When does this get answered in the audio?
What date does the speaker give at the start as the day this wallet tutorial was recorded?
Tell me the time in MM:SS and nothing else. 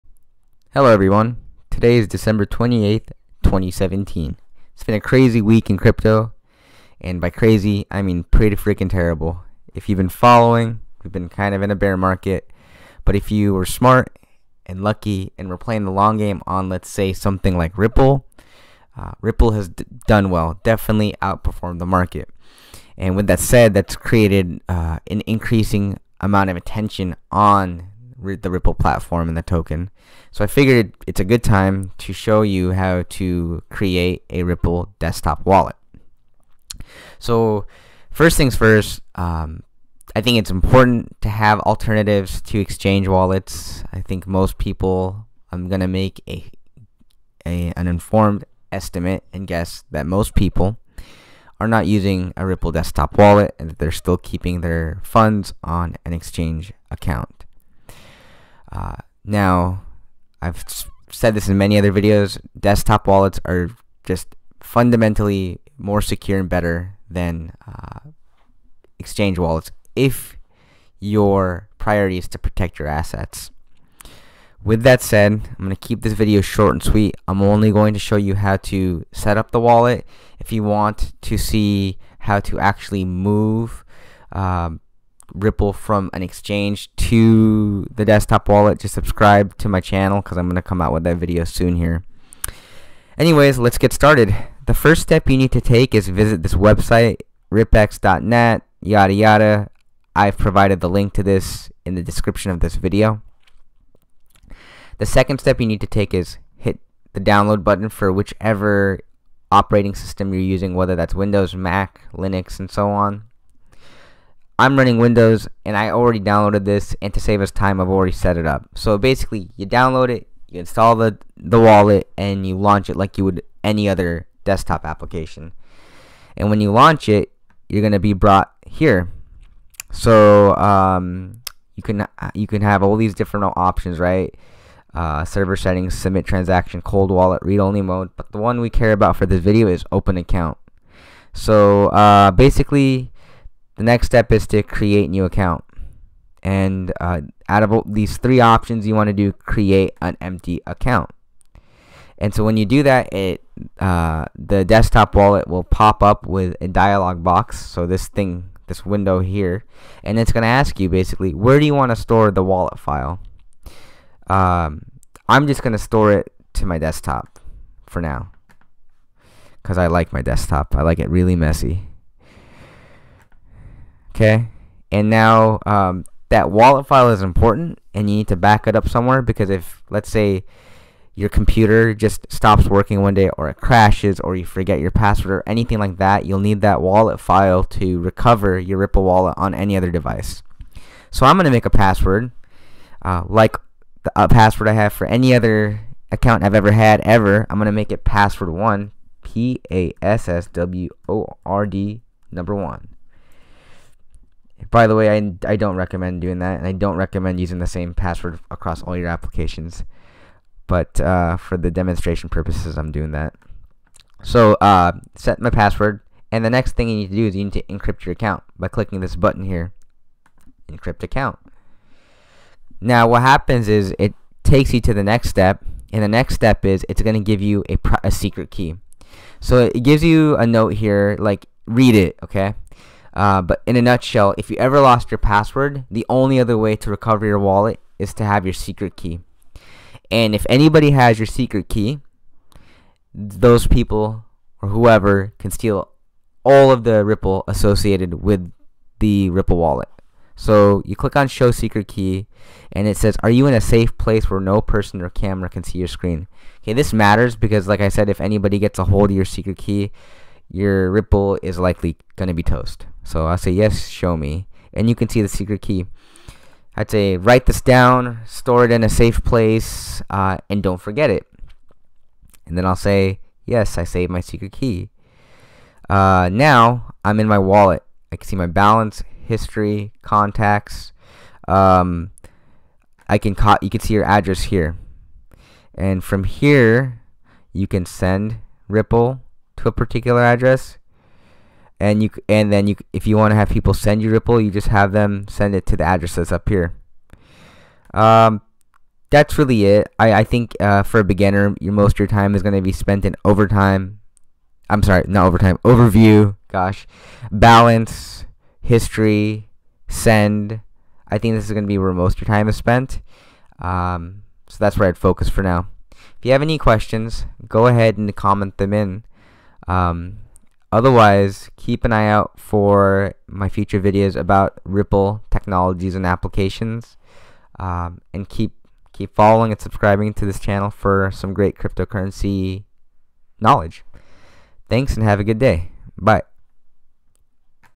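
00:02.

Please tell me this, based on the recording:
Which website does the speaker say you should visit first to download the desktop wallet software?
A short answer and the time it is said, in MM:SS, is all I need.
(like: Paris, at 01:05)
rippex.net, at 01:37.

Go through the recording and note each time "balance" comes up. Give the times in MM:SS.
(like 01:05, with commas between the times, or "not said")
04:38, 05:07.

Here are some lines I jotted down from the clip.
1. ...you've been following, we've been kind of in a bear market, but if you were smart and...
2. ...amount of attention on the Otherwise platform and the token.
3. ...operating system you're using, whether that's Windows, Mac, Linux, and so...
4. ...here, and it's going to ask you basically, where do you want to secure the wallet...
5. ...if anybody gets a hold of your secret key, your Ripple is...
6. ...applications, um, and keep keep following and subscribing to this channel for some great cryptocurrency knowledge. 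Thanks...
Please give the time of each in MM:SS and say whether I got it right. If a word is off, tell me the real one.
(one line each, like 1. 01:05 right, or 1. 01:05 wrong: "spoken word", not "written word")
1. 00:09 right
2. 00:26 wrong: "Ripple", not "Otherwise"
3. 01:49 right
4. 02:39 wrong: "store", not "secure"
5. 04:18 right
6. 05:26 right.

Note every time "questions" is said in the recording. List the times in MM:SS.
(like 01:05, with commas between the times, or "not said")
05:16.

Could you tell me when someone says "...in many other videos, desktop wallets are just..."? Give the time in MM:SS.
01:01.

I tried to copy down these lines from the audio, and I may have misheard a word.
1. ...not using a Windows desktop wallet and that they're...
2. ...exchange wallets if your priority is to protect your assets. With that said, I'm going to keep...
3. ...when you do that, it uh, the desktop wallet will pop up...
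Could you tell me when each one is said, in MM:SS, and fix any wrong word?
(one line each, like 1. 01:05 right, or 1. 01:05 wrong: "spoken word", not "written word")
1. 00:51 wrong: "Ripple", not "Windows"
2. 01:08 right
3. 02:32 right.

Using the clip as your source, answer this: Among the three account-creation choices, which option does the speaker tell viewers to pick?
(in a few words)
Create an empty account.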